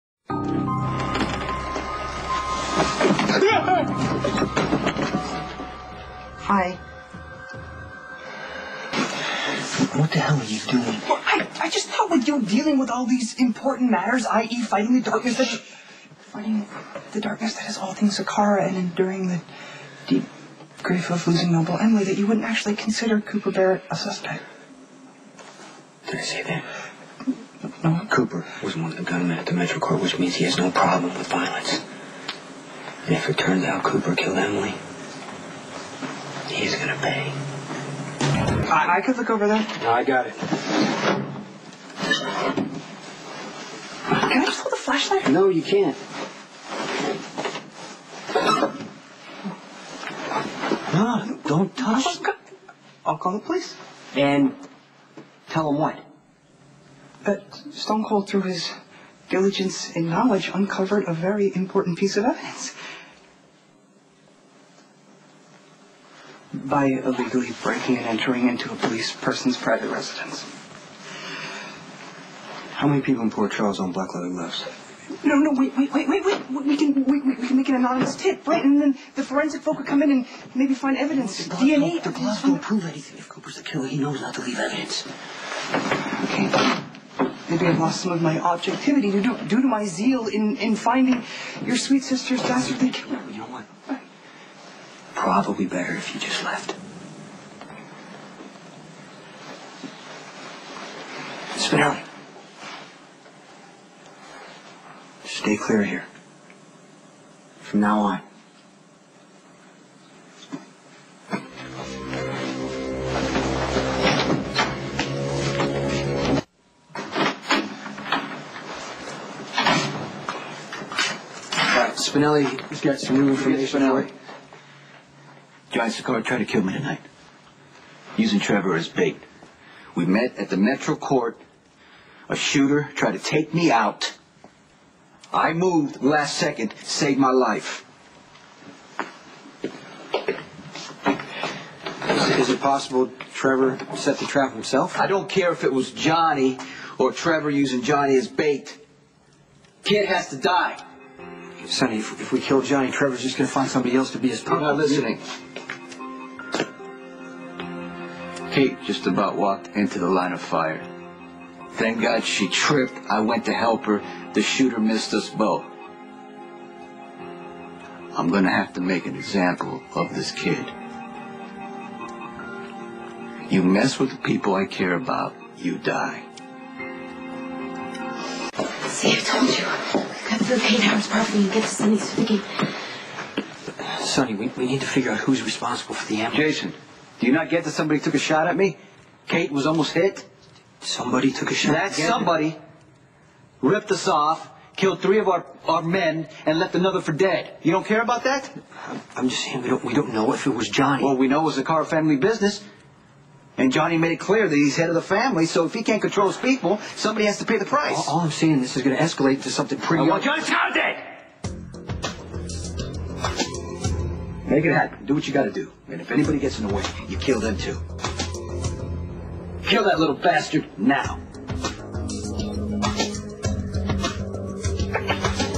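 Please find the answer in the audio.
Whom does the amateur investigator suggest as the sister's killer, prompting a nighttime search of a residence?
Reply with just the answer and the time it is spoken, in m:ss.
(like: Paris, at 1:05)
Cooper Barrett, at 0:23.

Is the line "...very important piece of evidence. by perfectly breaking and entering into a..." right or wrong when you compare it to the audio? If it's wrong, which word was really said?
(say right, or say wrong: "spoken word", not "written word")
wrong: "illegally", not "perfectly".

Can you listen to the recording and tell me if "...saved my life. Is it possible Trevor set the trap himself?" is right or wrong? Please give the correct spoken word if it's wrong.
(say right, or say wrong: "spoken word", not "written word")
right.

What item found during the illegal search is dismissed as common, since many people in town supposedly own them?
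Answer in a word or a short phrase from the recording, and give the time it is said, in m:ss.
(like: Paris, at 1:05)
Black leather gloves, at 1:13.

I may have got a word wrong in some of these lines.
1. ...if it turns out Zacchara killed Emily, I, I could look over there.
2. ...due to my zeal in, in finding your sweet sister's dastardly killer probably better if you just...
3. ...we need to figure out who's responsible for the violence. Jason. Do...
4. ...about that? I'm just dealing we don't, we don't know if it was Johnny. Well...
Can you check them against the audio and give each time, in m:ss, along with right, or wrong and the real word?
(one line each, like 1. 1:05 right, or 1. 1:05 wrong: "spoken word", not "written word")
1. 0:33 wrong: "Cooper", not "Zacchara"
2. 1:29 right
3. 3:04 wrong: "ambulance", not "violence"
4. 3:18 wrong: "saying", not "dealing".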